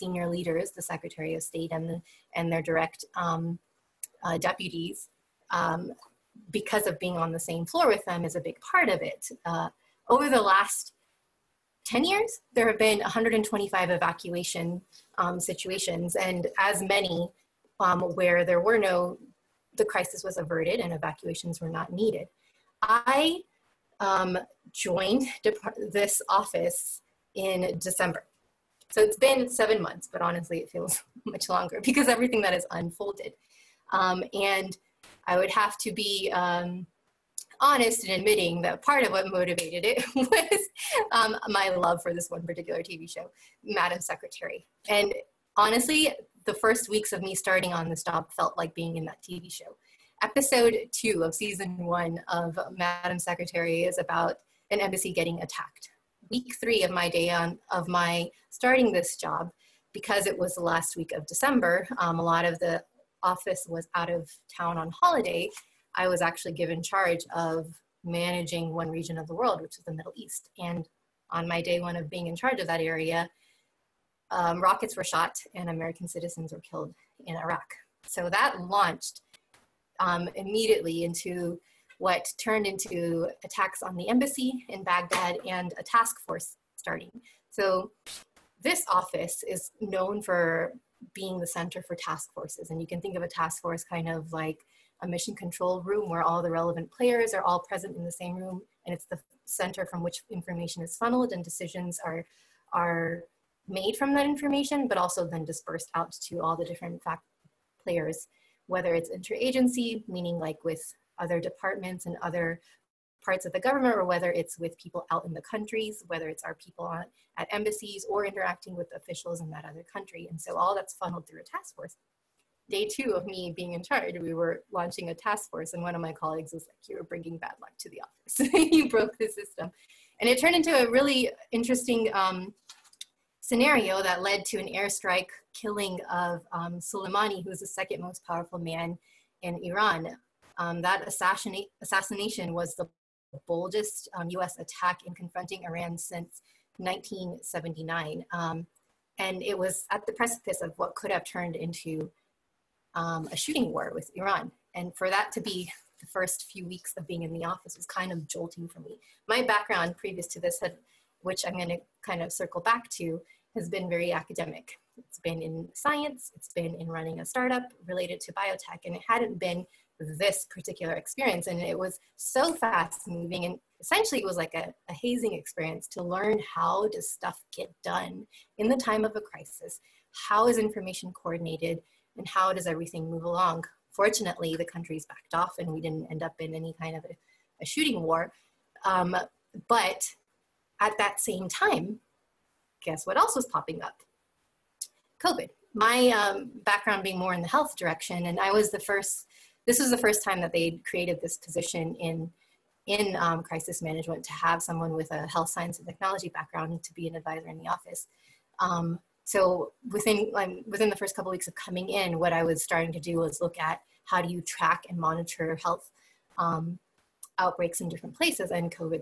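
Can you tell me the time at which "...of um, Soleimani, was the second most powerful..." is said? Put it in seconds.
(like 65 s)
136 s.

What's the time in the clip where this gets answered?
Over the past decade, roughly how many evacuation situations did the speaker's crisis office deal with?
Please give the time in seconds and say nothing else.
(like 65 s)
12 s.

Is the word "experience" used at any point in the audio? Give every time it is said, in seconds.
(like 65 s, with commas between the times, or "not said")
170 s, 175 s.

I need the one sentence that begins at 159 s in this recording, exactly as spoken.
My background previous to this had, which I'm going to kind of circle back to, has been very academic.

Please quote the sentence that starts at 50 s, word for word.
Episode two of season one of Madam Secretary is about an embassy getting attacked.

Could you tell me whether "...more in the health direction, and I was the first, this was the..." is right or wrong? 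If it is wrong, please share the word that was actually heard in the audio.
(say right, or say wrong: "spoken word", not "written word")
right.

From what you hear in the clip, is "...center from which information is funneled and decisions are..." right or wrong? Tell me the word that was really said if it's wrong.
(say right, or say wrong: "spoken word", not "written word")
right.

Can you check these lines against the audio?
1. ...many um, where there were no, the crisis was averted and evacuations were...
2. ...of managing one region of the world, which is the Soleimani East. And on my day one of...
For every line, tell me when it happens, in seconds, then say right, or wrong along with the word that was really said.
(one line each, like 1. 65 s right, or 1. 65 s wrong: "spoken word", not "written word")
1. 16 s right
2. 67 s wrong: "Middle", not "Soleimani".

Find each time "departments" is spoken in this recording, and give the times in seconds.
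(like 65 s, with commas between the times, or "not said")
111 s.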